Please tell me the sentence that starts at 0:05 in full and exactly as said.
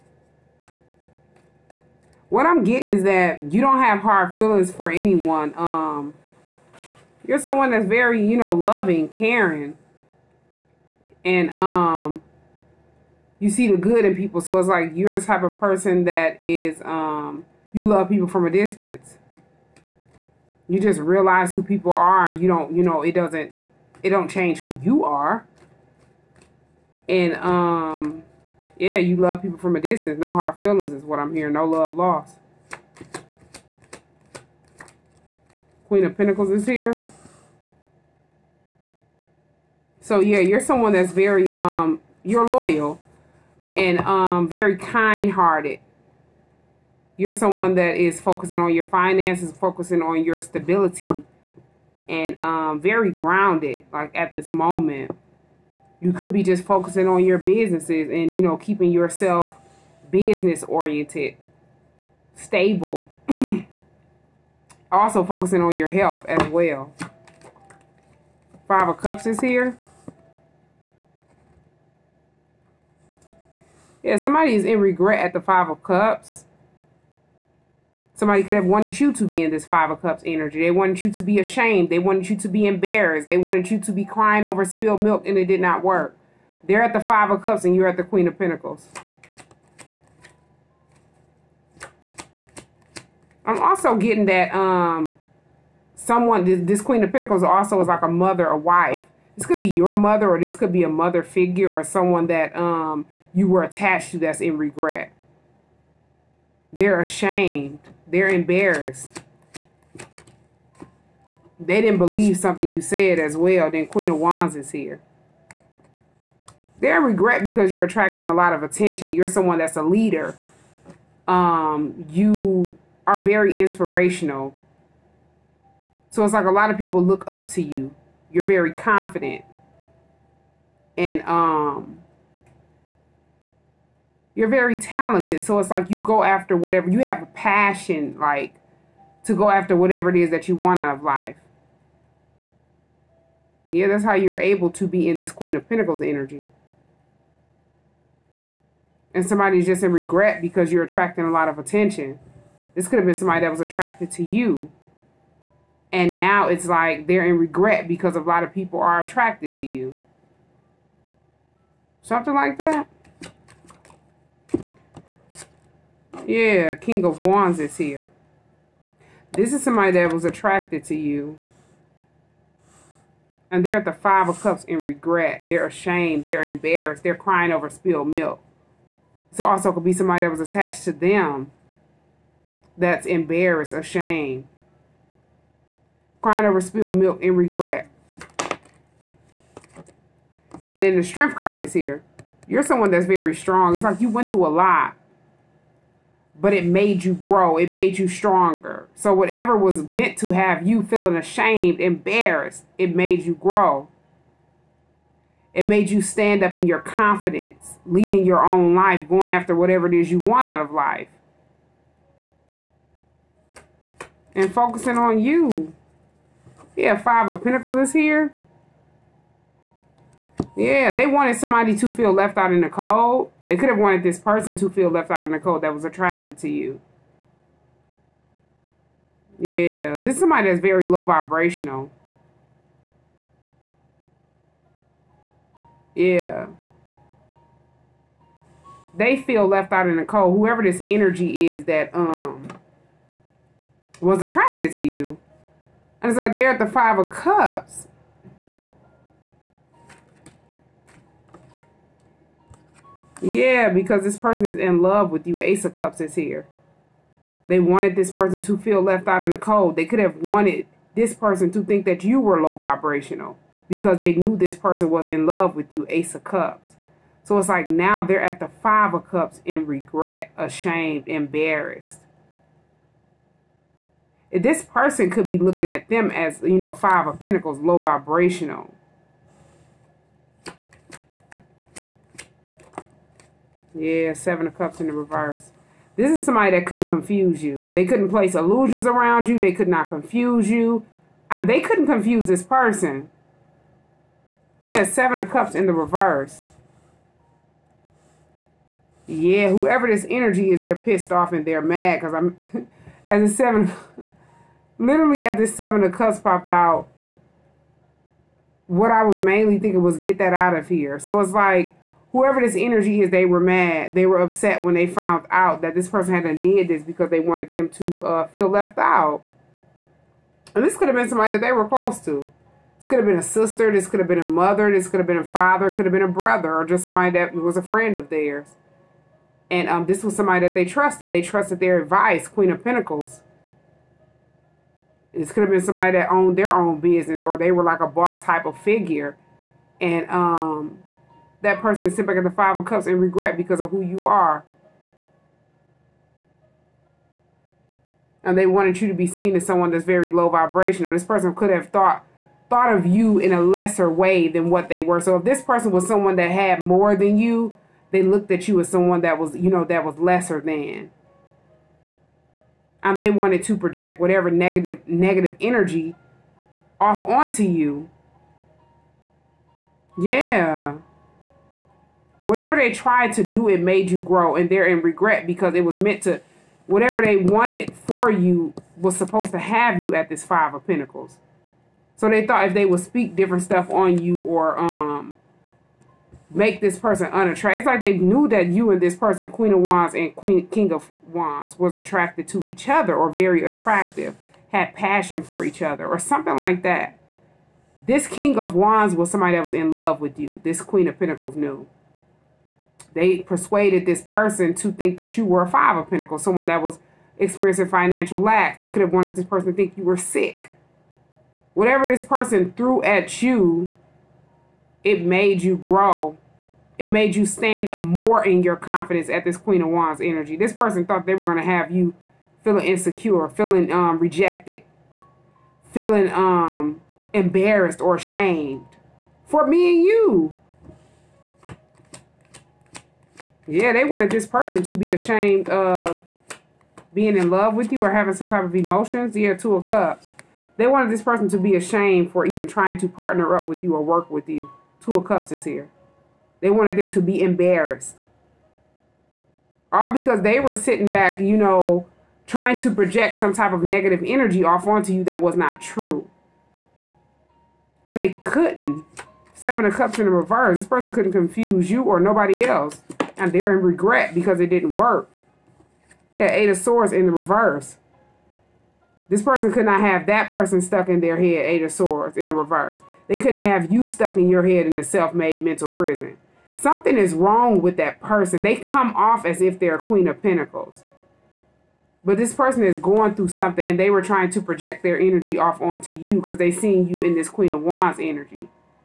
Um, you're someone that's very, you know, loving, caring.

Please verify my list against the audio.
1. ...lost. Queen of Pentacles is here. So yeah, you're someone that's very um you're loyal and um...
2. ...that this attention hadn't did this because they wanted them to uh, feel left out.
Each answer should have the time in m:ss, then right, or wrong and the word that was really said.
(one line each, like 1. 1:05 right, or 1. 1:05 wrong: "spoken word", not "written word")
1. 0:31 right
2. 5:15 wrong: "person", not "attention".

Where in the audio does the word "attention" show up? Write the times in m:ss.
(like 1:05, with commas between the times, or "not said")
1:58, 2:31.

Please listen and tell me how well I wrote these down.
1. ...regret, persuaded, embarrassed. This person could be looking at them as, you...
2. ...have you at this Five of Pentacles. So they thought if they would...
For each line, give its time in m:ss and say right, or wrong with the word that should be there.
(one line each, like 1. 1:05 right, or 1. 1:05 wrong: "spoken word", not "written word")
1. 4:29 wrong: "ashamed", not "persuaded"
2. 6:19 right.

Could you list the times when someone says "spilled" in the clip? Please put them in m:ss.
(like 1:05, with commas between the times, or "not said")
1:24, 2:57, 3:06.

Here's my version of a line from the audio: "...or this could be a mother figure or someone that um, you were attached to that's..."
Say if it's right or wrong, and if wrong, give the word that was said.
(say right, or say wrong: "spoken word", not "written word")
right.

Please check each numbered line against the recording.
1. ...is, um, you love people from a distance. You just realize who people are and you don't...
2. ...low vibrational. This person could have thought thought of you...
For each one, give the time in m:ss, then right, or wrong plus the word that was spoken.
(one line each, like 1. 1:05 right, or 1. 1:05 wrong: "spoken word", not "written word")
1. 0:16 right
2. 5:50 right.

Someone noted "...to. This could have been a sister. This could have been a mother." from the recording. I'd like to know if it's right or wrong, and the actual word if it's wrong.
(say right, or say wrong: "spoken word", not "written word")
right.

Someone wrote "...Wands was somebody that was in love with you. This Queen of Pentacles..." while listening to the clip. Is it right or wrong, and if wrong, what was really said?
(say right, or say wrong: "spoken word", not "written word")
right.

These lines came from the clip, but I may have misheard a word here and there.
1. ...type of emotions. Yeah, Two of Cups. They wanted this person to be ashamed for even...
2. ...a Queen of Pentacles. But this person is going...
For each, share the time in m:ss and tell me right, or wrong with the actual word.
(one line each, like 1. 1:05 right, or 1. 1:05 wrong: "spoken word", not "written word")
1. 7:18 right
2. 7:59 right.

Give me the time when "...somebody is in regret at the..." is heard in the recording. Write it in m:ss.
1:14.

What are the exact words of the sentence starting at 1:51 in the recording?
They didn't believe something you said as well.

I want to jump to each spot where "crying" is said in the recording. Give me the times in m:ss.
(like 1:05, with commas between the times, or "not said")
1:24, 2:57, 3:06.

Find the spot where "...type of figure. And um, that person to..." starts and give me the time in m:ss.
5:38.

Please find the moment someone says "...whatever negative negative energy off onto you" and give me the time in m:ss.
6:03.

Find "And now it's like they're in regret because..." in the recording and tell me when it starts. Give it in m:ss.
2:35.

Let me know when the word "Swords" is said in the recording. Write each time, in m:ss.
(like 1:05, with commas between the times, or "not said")
7:46, 7:51.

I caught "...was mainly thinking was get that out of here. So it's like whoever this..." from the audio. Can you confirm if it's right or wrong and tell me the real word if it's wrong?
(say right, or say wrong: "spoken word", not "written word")
right.